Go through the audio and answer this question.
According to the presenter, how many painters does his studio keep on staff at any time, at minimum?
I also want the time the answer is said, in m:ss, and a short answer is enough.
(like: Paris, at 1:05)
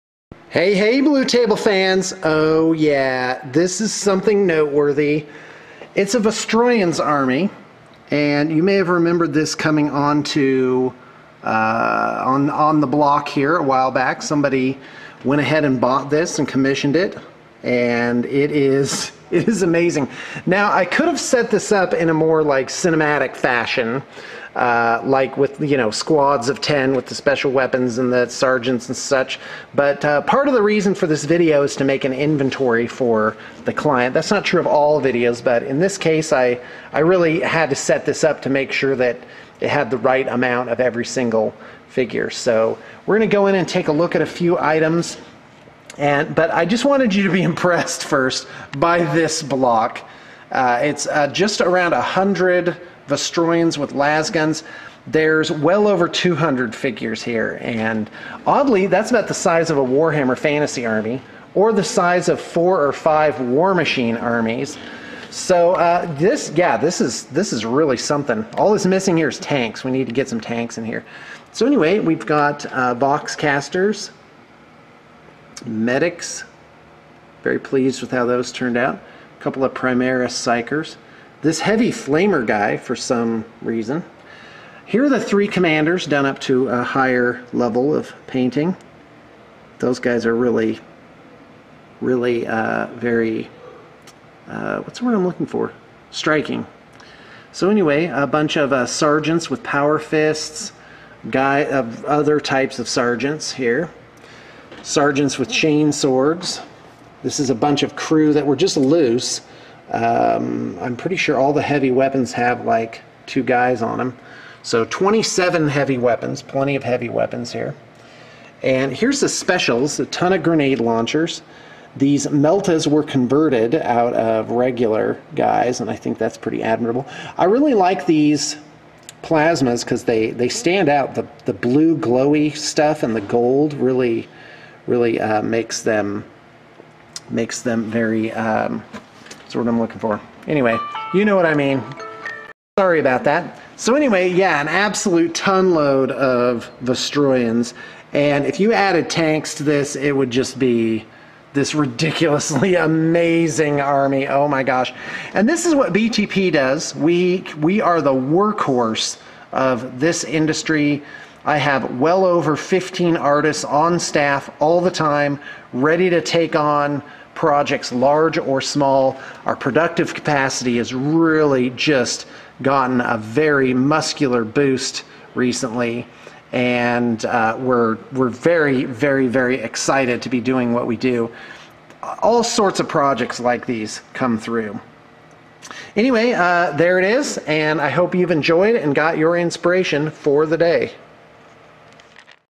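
15, at 2:42.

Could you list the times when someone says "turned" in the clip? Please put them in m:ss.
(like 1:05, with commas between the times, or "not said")
1:18.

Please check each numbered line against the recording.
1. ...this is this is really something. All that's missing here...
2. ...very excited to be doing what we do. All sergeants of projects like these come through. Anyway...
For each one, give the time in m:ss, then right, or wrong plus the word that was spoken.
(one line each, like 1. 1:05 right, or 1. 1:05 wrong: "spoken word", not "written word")
1. 1:06 right
2. 2:59 wrong: "sorts", not "sergeants".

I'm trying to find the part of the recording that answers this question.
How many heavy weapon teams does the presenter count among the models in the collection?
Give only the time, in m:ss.
1:54.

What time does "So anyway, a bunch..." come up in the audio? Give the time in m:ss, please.
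1:37.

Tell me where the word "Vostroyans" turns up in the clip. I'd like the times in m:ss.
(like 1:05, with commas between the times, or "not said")
0:06, 0:53, 2:26.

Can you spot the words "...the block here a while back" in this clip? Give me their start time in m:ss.
0:12.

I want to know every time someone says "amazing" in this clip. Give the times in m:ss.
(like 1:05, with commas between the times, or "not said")
0:19, 2:32.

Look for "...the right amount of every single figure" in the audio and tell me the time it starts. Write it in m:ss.
0:39.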